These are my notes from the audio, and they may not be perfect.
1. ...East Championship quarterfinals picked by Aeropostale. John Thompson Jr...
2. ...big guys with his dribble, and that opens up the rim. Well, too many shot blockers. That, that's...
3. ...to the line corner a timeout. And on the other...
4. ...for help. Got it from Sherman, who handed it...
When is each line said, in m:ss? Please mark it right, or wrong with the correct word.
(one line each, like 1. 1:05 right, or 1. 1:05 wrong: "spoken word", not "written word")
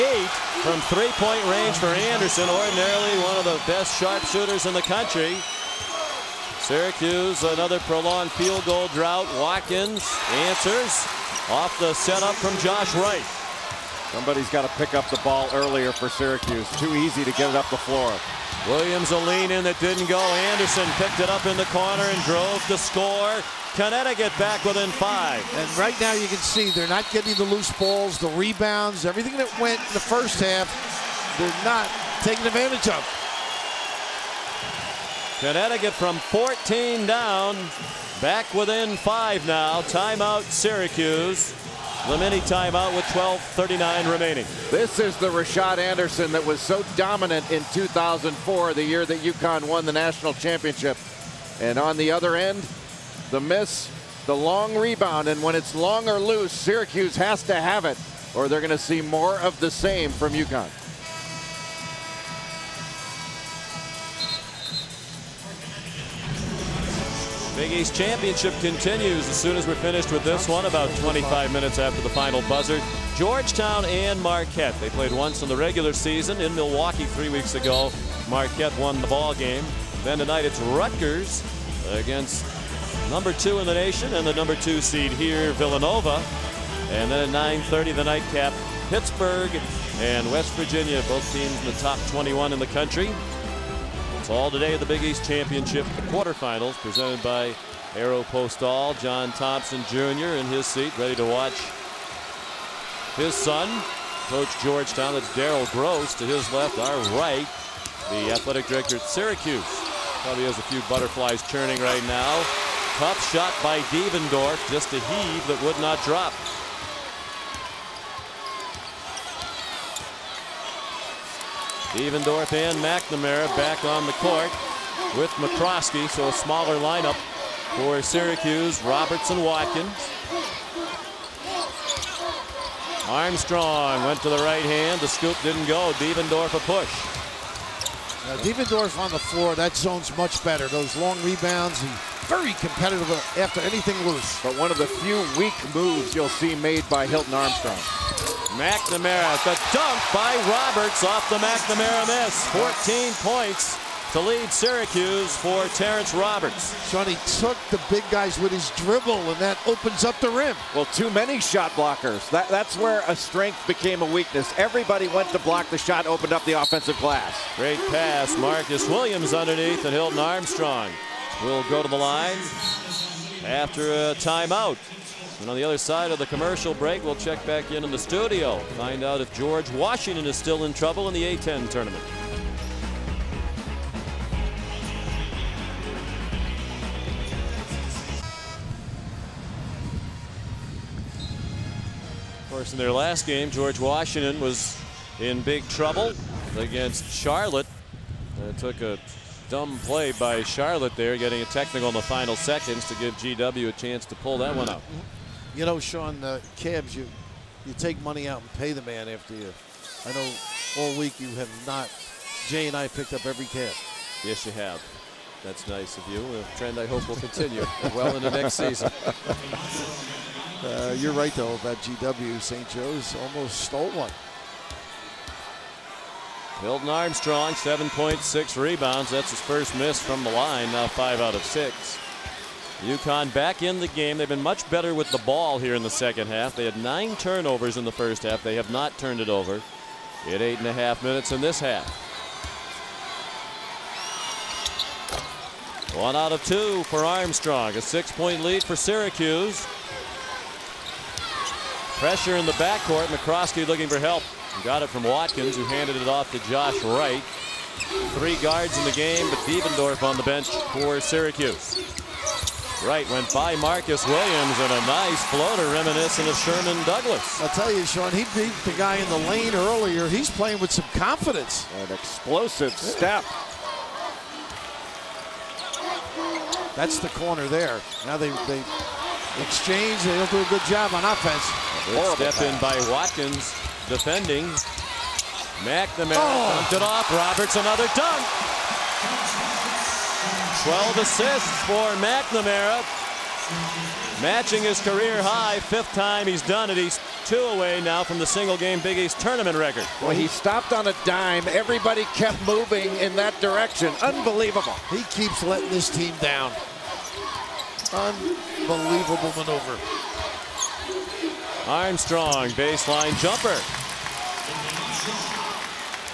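1. 1:35 wrong: "presented", not "picked"
2. 2:37 right
3. 2:51 wrong: "after", not "corner"
4. 4:13 wrong: "Watkins", not "Sherman".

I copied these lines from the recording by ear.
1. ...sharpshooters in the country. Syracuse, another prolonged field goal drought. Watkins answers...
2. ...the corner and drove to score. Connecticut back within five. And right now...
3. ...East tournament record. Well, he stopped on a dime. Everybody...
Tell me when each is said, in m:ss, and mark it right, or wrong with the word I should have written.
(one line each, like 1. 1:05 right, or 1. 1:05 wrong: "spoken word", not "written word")
1. 0:04 right
2. 0:21 right
3. 4:58 right.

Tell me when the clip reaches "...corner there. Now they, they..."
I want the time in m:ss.
4:37.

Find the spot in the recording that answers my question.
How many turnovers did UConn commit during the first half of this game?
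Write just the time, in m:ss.
3:56.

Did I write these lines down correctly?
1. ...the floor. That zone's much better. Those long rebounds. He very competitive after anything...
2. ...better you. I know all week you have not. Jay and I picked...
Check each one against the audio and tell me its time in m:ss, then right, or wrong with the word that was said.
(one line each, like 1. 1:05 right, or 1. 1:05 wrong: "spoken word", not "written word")
1. 2:19 right
2. 3:29 wrong: "after", not "better".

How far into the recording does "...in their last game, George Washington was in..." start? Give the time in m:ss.
3:12.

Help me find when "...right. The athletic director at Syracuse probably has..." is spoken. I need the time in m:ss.
1:47.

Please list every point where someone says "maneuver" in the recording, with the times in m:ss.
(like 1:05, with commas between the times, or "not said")
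5:09.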